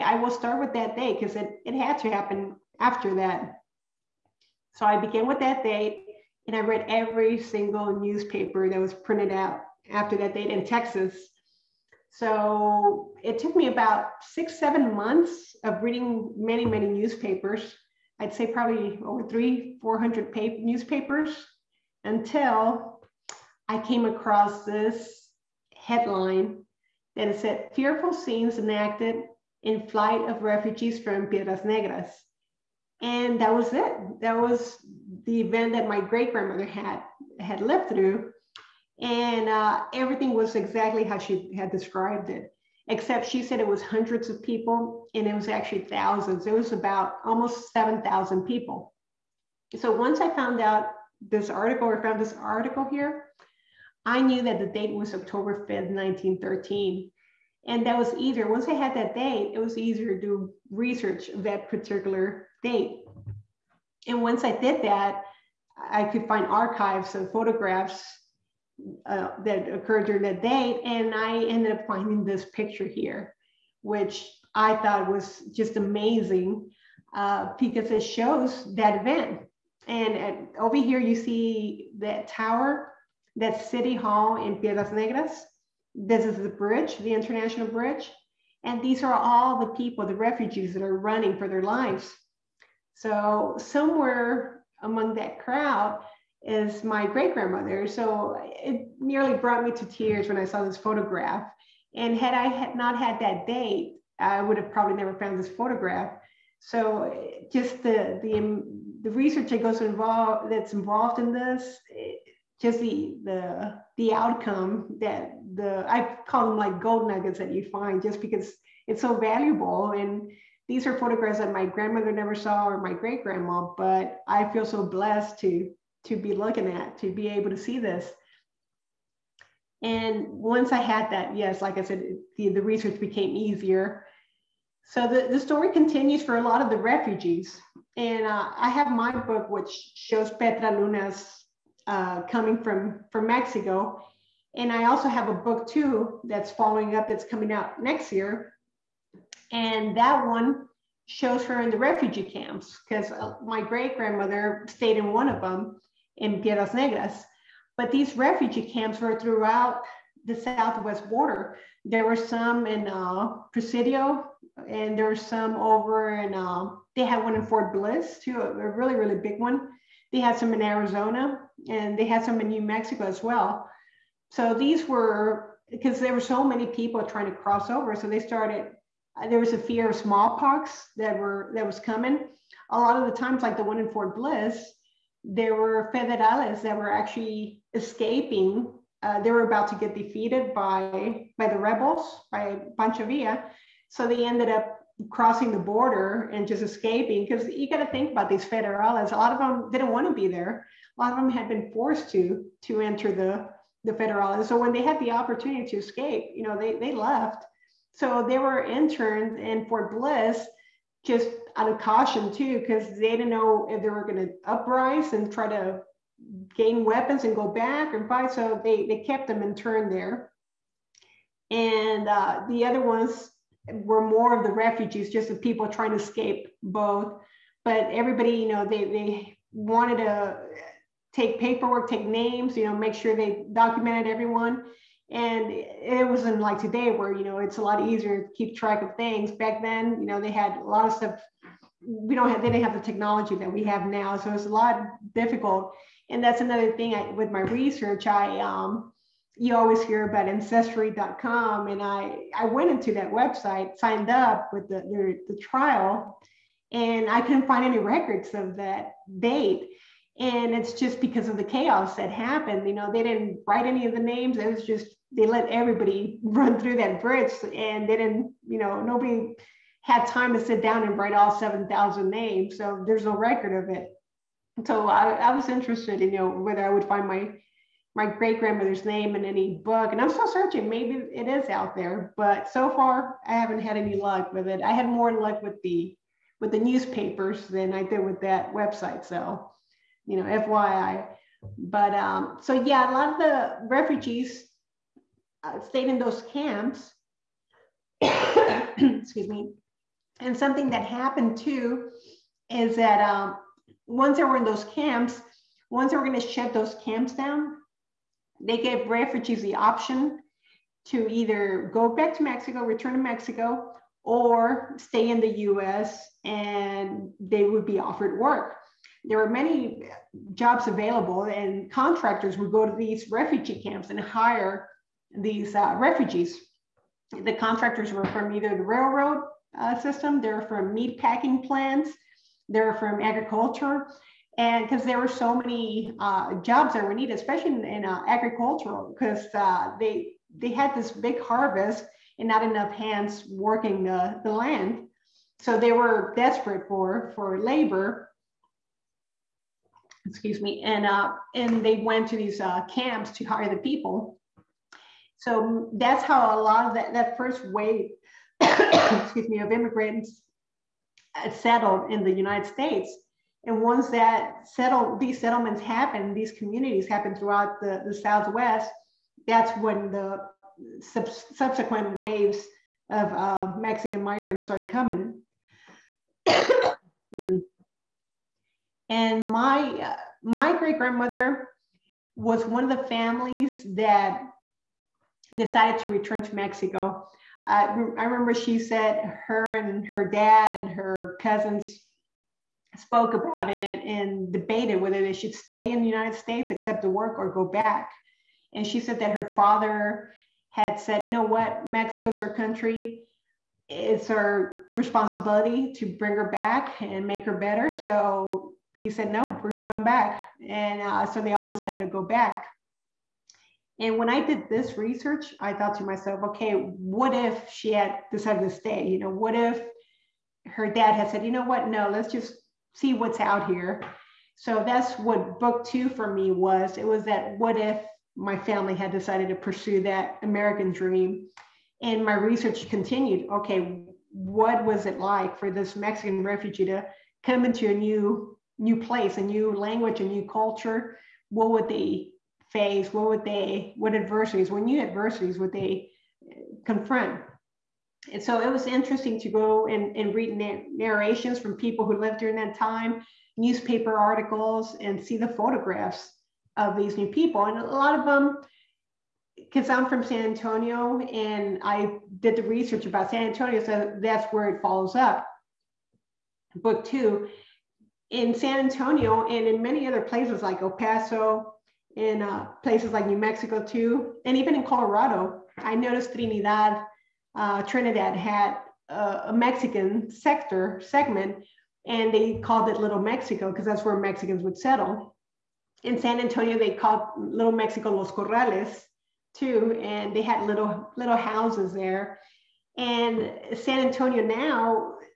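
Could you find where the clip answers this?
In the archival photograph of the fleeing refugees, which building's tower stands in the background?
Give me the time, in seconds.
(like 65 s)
83 s.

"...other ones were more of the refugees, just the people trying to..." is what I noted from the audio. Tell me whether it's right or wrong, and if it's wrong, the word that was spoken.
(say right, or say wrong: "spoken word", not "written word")
right.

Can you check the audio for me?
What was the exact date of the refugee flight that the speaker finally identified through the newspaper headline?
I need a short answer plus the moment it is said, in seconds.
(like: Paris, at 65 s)
October 5, 1913, at 55 s.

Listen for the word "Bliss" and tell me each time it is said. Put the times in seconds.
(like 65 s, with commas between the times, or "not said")
167 s, 184 s, 209 s.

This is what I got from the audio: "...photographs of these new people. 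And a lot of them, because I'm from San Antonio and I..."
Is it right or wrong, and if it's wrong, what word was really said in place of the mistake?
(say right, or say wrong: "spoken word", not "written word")
right.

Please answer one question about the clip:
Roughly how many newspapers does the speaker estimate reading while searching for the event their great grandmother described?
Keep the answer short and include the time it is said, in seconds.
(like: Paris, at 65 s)
300-400, at 19 s.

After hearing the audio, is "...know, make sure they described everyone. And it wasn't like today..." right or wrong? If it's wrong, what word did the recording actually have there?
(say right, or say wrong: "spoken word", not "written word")
wrong: "documented", not "described".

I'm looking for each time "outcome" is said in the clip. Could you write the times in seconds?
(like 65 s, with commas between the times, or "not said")
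114 s.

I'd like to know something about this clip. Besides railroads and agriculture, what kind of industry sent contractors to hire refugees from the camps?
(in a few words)
Meat packing plants.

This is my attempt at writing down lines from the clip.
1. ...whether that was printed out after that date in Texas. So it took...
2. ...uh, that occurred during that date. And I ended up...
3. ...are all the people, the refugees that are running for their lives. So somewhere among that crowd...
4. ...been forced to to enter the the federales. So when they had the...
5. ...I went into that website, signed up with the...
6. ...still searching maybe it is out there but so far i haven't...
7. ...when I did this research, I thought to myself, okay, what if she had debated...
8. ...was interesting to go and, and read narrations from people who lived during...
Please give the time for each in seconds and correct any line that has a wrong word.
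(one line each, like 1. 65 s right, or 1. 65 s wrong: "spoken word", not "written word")
1. 7 s wrong: "newspaper", not "whether"
2. 69 s right
3. 89 s right
4. 201 s right
5. 252 s right
6. 280 s right
7. 413 s wrong: "decided", not "debated"
8. 448 s right.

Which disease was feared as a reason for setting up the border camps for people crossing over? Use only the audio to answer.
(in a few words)
Smallpox.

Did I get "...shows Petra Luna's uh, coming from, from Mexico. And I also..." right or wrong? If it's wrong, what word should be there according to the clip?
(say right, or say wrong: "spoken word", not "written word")
right.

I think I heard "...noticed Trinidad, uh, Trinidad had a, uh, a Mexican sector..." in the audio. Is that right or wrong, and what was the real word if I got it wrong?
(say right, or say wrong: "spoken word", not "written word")
right.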